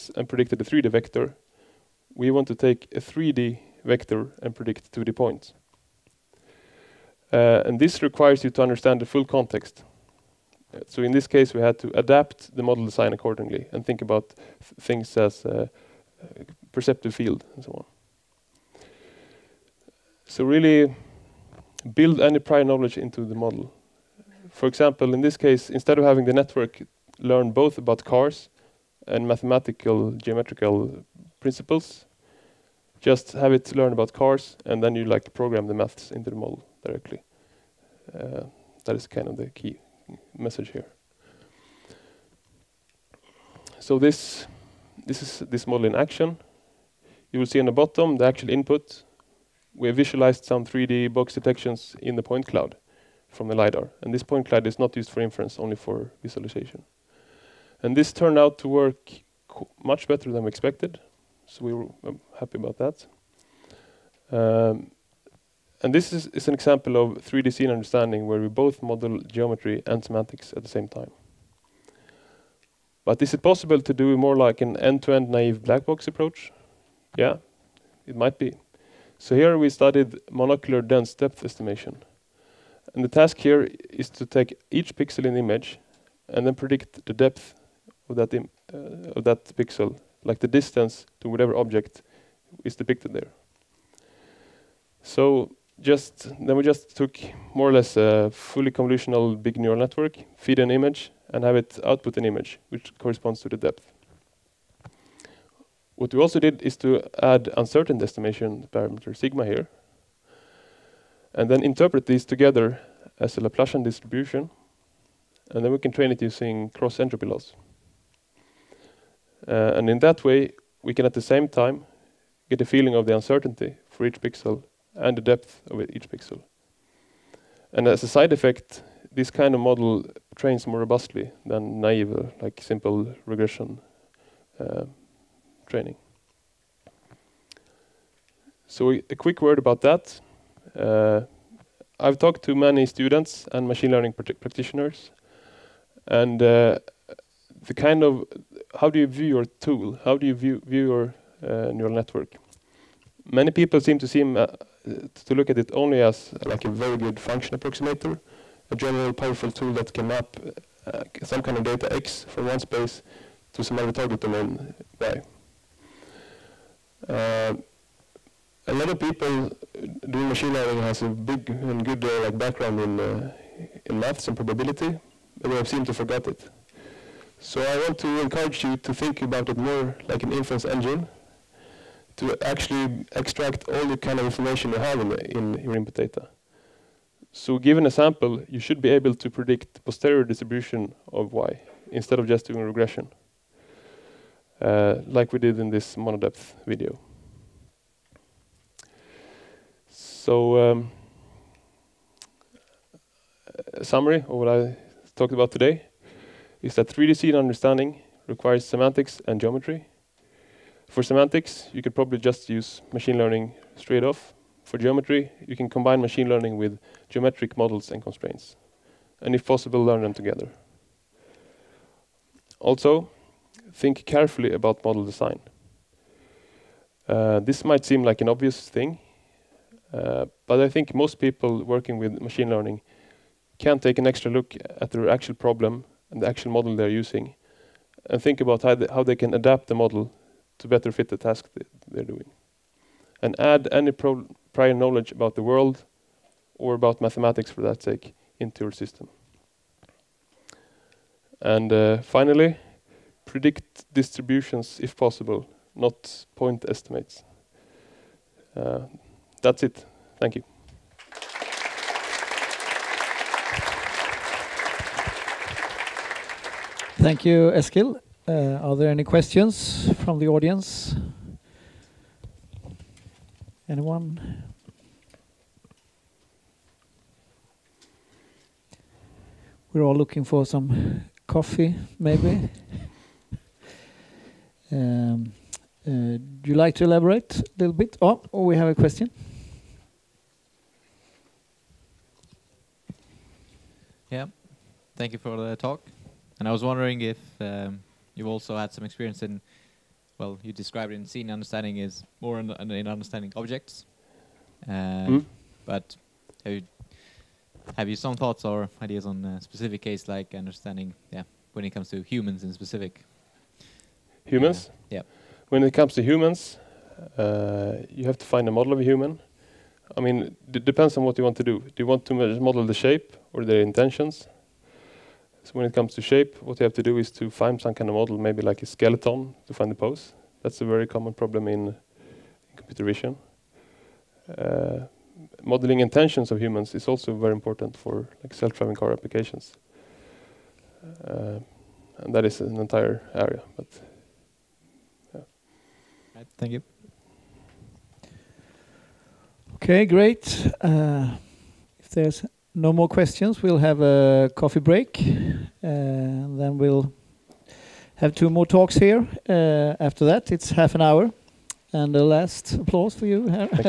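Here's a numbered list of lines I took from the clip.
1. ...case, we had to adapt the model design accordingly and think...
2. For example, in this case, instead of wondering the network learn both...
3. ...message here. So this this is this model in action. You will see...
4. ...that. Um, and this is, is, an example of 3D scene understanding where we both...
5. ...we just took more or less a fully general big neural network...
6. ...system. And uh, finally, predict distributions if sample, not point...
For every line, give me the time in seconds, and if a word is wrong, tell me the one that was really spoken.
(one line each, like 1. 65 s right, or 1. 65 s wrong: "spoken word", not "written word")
1. 11 s right
2. 24 s wrong: "having", not "wondering"
3. 40 s right
4. 62 s right
5. 96 s wrong: "convolutional", not "general"
6. 248 s wrong: "possible", not "sample".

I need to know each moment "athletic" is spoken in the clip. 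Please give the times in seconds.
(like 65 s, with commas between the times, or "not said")
not said.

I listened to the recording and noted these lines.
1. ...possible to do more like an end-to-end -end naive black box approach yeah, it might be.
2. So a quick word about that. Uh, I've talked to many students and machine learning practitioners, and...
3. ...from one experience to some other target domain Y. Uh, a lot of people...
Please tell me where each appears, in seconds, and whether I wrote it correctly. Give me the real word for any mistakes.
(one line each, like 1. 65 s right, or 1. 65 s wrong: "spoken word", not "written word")
1. 73 s right
2. 138 s right
3. 162 s wrong: "space", not "experience".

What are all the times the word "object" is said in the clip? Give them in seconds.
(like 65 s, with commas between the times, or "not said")
91 s, 303 s.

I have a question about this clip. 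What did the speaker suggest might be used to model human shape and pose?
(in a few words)
a skeleton.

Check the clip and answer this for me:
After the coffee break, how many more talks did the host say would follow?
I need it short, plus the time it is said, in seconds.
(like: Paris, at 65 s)
2, at 358 s.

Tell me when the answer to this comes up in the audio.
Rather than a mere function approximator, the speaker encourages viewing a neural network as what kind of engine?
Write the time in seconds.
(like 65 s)
180 s.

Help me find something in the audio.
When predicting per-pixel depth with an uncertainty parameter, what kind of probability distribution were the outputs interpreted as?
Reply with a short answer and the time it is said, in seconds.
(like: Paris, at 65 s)
Laplacian distribution, at 113 s.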